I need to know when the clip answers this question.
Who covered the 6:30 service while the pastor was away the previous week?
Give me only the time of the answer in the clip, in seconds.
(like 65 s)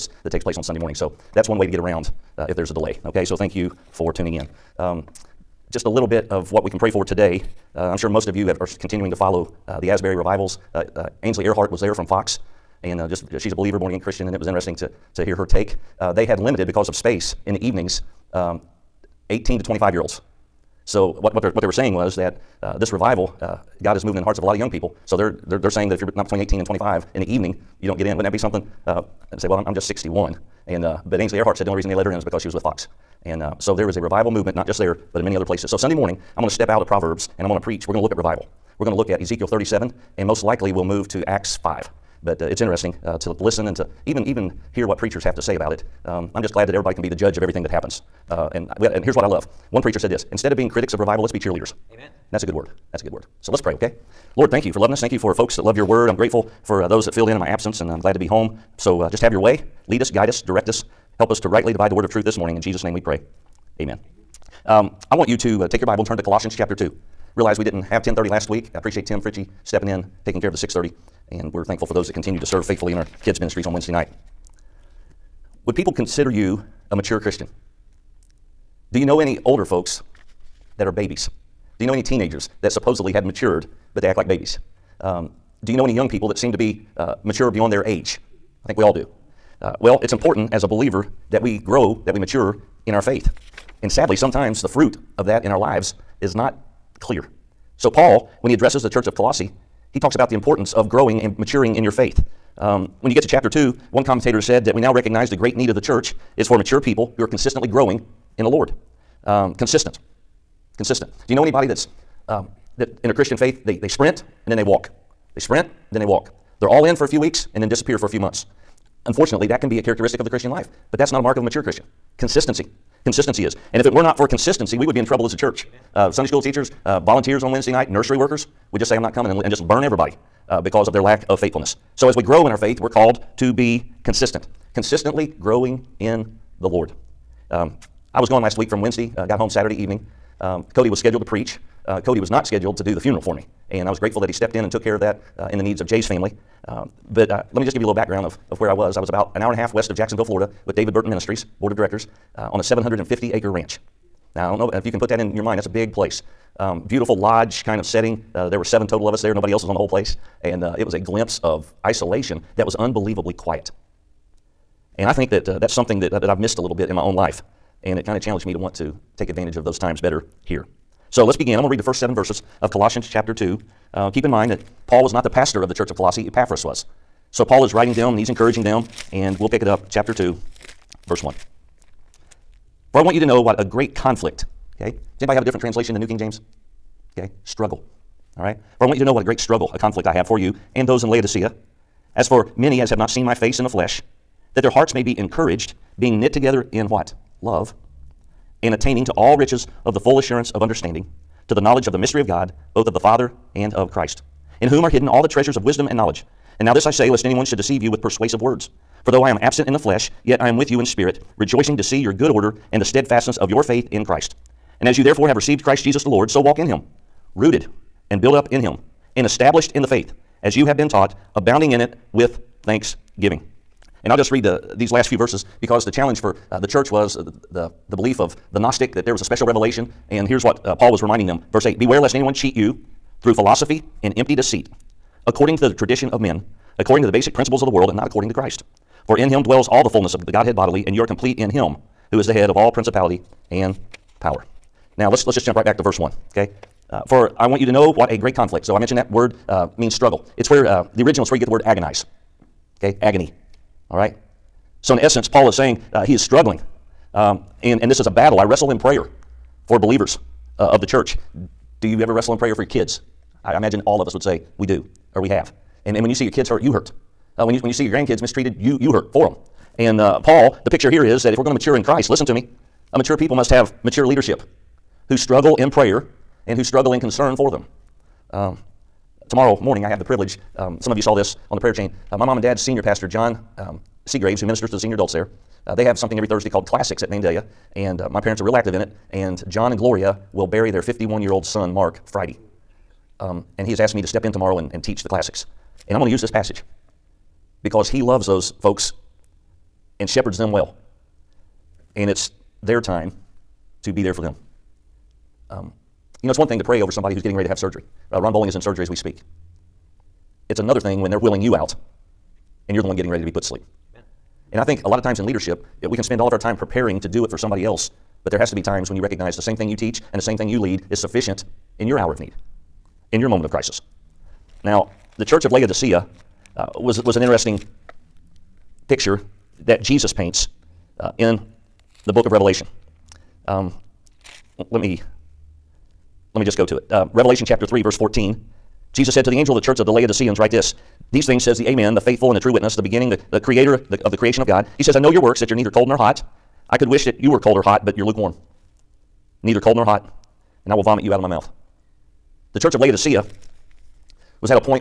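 69 s.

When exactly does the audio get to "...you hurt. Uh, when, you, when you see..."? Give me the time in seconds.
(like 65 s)
266 s.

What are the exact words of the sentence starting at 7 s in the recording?
Uh, I'm sure most of you have, are continuing to follow uh, the Asbury revivals.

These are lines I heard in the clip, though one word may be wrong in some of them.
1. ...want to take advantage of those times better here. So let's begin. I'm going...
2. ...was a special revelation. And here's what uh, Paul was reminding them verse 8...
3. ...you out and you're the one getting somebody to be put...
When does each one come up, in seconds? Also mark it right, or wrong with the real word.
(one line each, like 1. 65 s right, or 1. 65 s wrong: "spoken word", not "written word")
1. 168 s right
2. 229 s right
3. 311 s wrong: "ready", not "somebody".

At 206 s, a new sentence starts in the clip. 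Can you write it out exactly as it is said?
And now this I say, lest anyone should deceive you with persuasive words.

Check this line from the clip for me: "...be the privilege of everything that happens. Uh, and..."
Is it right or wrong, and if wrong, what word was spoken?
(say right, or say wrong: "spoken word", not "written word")
wrong: "judge", not "privilege".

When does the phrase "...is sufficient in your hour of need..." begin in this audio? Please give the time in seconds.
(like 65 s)
320 s.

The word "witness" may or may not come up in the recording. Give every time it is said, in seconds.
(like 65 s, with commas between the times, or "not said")
342 s.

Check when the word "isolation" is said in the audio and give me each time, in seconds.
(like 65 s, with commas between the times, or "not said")
161 s.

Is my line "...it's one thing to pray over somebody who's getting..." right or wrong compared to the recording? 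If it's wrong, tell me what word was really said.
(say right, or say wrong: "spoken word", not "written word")
right.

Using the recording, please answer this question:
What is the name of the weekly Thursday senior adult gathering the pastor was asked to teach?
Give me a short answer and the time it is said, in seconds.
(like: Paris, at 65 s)
Classics at Mandela, at 286 s.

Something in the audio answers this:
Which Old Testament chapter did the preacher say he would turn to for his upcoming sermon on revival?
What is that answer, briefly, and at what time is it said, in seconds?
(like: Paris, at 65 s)
Ezekiel 37, at 39 s.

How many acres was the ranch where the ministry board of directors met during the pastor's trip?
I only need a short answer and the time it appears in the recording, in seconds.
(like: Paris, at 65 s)
750, at 152 s.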